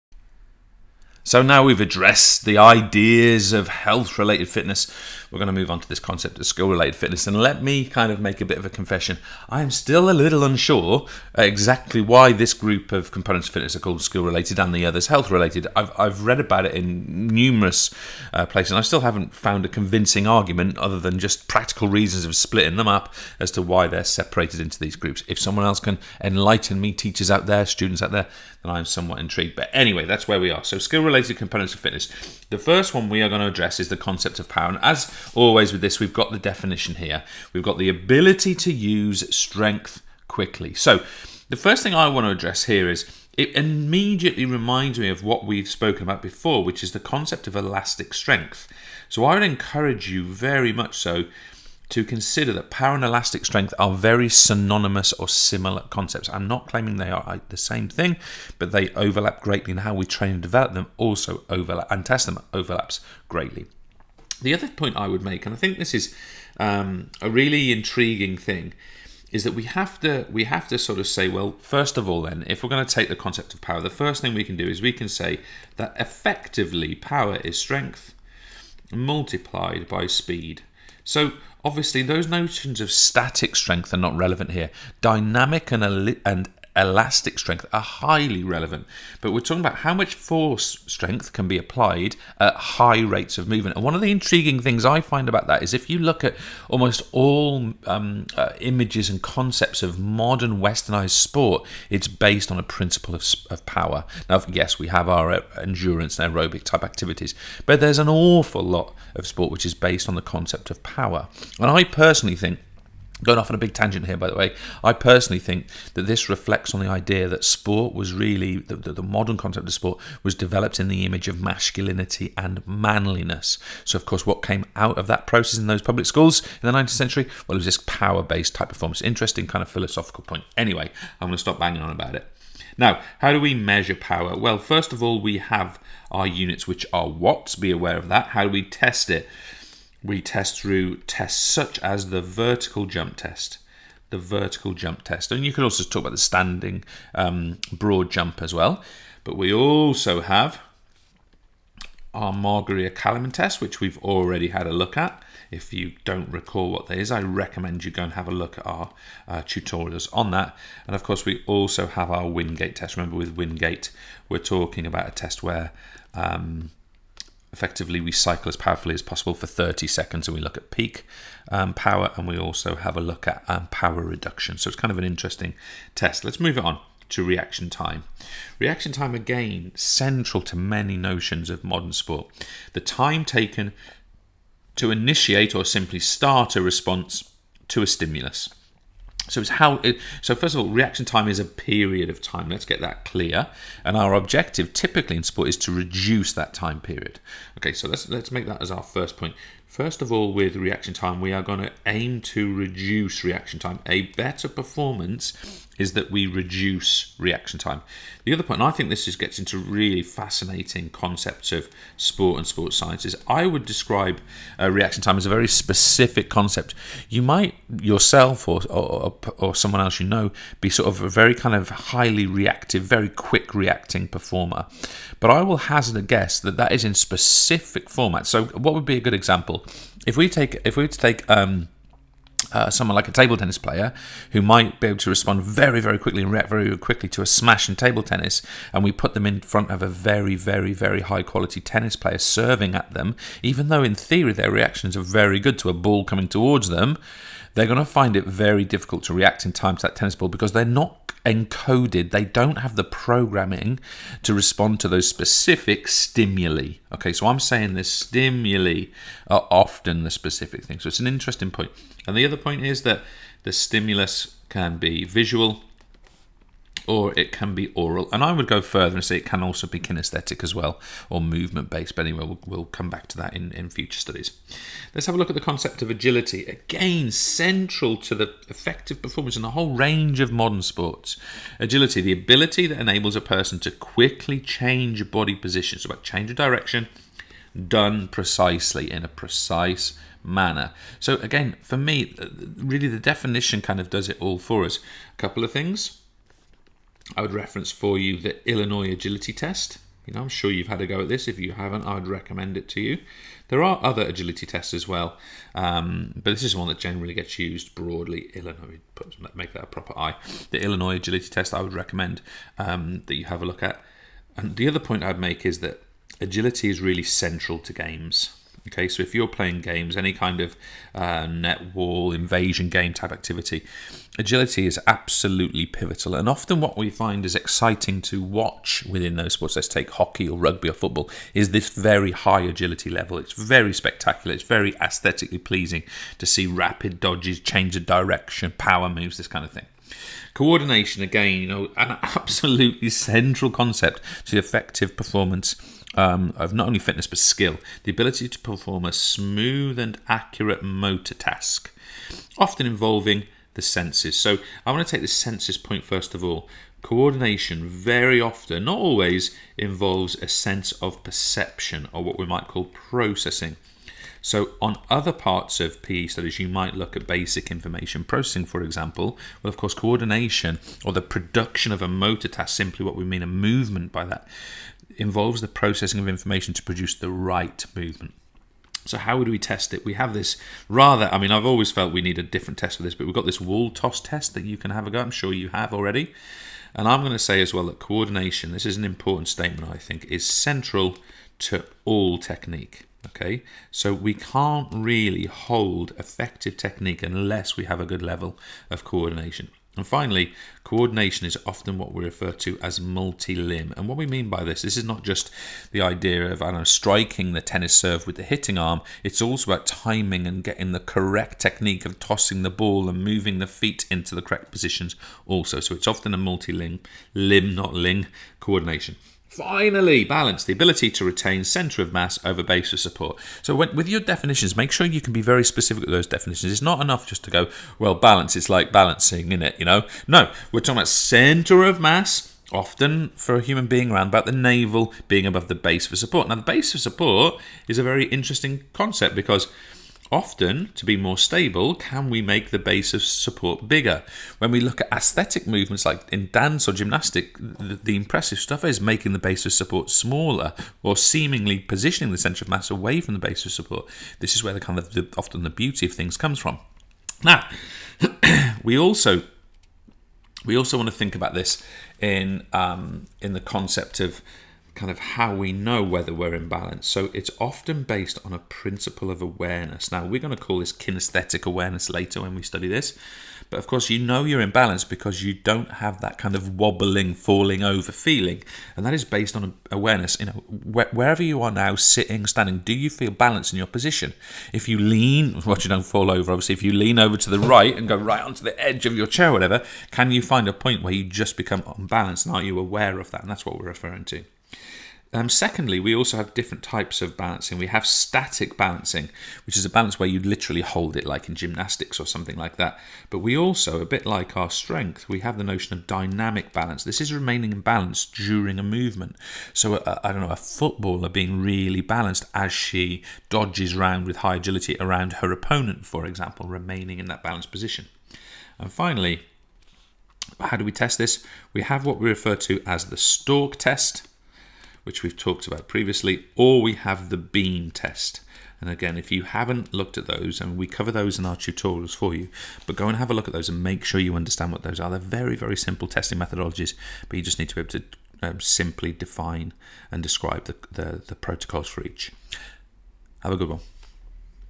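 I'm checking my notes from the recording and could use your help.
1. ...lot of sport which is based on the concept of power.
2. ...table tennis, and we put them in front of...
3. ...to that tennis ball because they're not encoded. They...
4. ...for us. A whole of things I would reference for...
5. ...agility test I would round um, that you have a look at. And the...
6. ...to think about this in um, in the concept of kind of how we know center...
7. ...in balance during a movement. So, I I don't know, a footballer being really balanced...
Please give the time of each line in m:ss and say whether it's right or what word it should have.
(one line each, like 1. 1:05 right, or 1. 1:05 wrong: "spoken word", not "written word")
1. 1:48 right
2. 3:57 right
3. 4:09 right
4. 4:54 wrong: "couple", not "whole"
5. 5:10 wrong: "recommend", not "round"
6. 7:40 wrong: "whether", not "center"
7. 8:27 right.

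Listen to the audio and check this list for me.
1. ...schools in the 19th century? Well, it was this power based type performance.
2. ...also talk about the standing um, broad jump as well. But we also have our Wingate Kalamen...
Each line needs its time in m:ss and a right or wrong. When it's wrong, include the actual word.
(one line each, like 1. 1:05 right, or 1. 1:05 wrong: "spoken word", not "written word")
1. 2:06 right
2. 2:25 wrong: "Margaria", not "Wingate".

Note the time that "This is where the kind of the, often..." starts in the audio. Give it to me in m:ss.
7:34.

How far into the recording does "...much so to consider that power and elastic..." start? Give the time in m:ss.
0:50.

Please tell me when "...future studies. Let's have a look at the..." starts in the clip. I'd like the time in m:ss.
4:33.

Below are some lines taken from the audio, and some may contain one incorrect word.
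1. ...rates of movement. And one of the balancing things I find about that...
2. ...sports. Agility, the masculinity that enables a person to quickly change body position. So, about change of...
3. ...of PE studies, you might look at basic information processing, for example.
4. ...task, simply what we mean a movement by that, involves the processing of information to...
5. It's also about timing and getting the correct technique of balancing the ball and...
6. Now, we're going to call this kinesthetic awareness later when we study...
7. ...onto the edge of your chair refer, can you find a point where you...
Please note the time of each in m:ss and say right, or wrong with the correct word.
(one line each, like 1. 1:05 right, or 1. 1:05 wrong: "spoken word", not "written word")
1. 1:33 wrong: "intriguing", not "balancing"
2. 4:40 wrong: "ability", not "masculinity"
3. 6:05 right
4. 6:12 right
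5. 6:49 wrong: "tossing", not "balancing"
6. 7:49 right
7. 8:08 wrong: "whatever", not "refer".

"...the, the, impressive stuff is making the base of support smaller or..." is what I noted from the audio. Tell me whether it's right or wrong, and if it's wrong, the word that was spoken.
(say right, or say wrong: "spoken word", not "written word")
right.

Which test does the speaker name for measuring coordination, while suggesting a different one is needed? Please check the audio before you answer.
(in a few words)
wall toss test.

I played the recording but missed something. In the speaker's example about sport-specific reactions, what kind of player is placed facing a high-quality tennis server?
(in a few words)
table tennis player.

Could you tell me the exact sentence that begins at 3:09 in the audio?
It, so first of all, reaction time is a period of time.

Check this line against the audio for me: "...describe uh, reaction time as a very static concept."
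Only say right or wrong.
wrong.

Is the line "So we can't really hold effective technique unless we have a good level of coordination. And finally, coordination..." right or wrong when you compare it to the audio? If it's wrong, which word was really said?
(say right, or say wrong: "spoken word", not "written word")
right.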